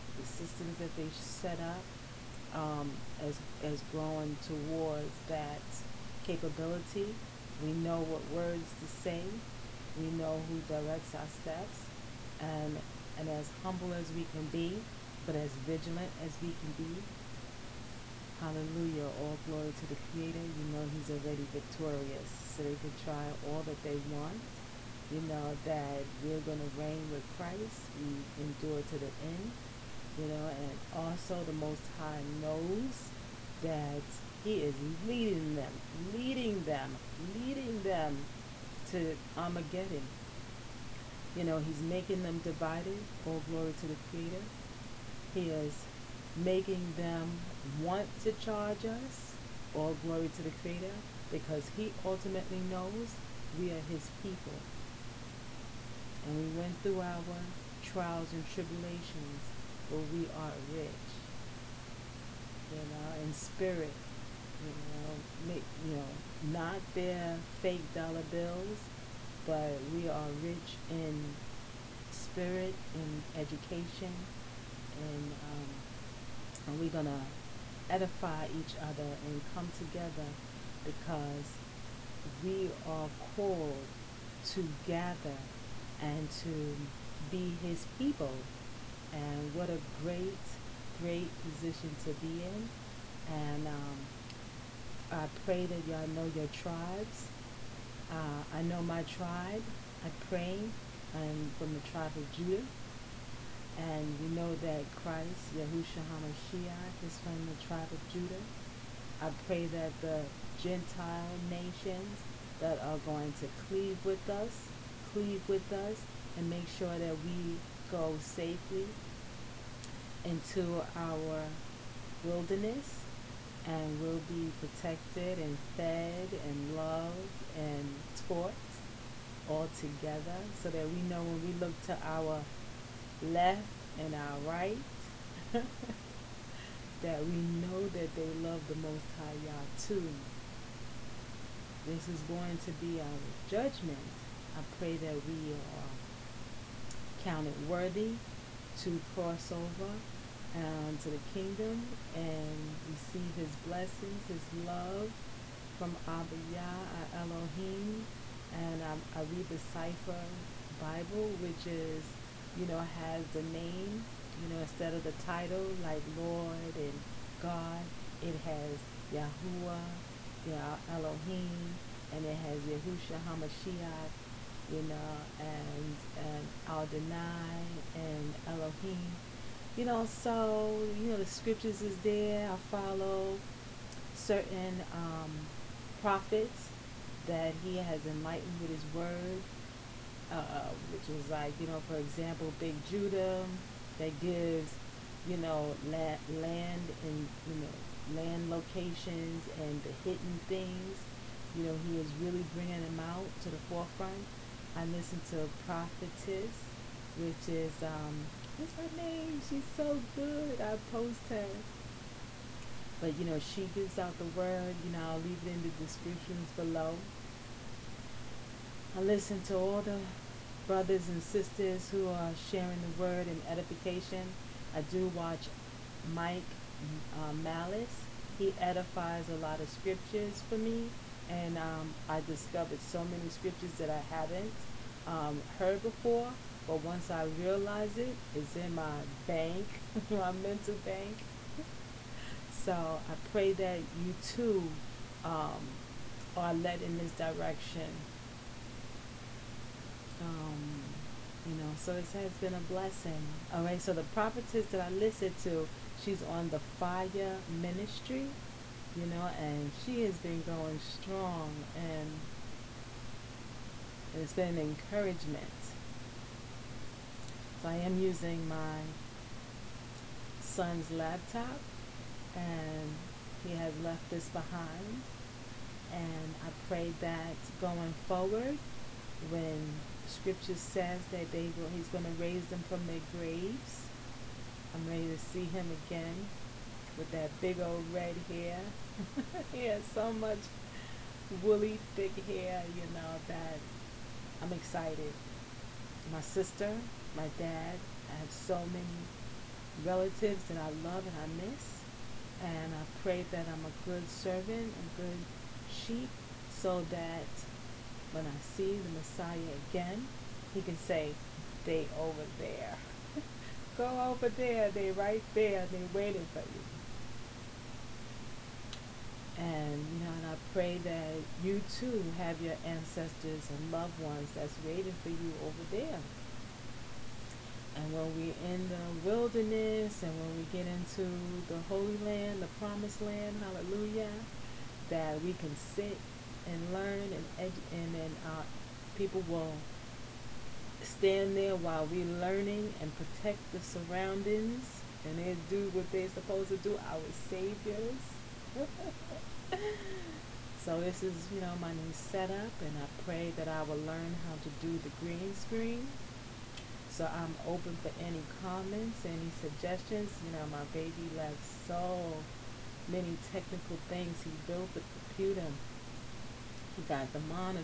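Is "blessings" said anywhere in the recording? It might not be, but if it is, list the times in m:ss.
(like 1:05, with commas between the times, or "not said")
2:33, 4:12.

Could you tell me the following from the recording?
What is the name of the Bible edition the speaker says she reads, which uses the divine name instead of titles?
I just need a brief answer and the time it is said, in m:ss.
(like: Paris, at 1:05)
Cepher Bible, at 2:39.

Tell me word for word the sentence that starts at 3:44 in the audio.
I do watch Mike uh, Malice.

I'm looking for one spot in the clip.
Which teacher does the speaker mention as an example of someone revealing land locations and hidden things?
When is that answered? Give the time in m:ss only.
3:12.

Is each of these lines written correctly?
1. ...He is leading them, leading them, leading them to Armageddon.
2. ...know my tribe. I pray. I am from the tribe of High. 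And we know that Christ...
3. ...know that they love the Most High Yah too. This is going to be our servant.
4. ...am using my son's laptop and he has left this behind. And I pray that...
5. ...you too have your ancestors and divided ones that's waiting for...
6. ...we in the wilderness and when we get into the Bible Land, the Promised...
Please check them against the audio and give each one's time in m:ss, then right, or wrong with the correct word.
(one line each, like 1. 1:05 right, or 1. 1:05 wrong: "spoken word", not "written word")
1. 0:34 right
2. 1:38 wrong: "Judah", not "High"
3. 2:17 wrong: "judgment", not "servant"
4. 4:27 right
5. 5:21 wrong: "loved", not "divided"
6. 5:28 wrong: "Holy", not "Bible".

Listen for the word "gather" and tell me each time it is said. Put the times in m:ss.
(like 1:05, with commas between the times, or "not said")
1:24.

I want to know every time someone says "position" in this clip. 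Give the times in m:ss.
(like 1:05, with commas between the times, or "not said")
1:31.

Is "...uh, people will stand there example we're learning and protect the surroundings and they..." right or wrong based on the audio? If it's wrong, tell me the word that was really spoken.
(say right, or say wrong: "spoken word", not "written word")
wrong: "while", not "example".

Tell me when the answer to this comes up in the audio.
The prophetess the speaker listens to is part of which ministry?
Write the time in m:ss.
4:16.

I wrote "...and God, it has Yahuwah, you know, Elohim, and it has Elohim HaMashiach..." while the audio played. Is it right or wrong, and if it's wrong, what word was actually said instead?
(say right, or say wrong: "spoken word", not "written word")
wrong: "Yahusha", not "Elohim".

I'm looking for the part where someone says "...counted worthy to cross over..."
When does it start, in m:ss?
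2:27.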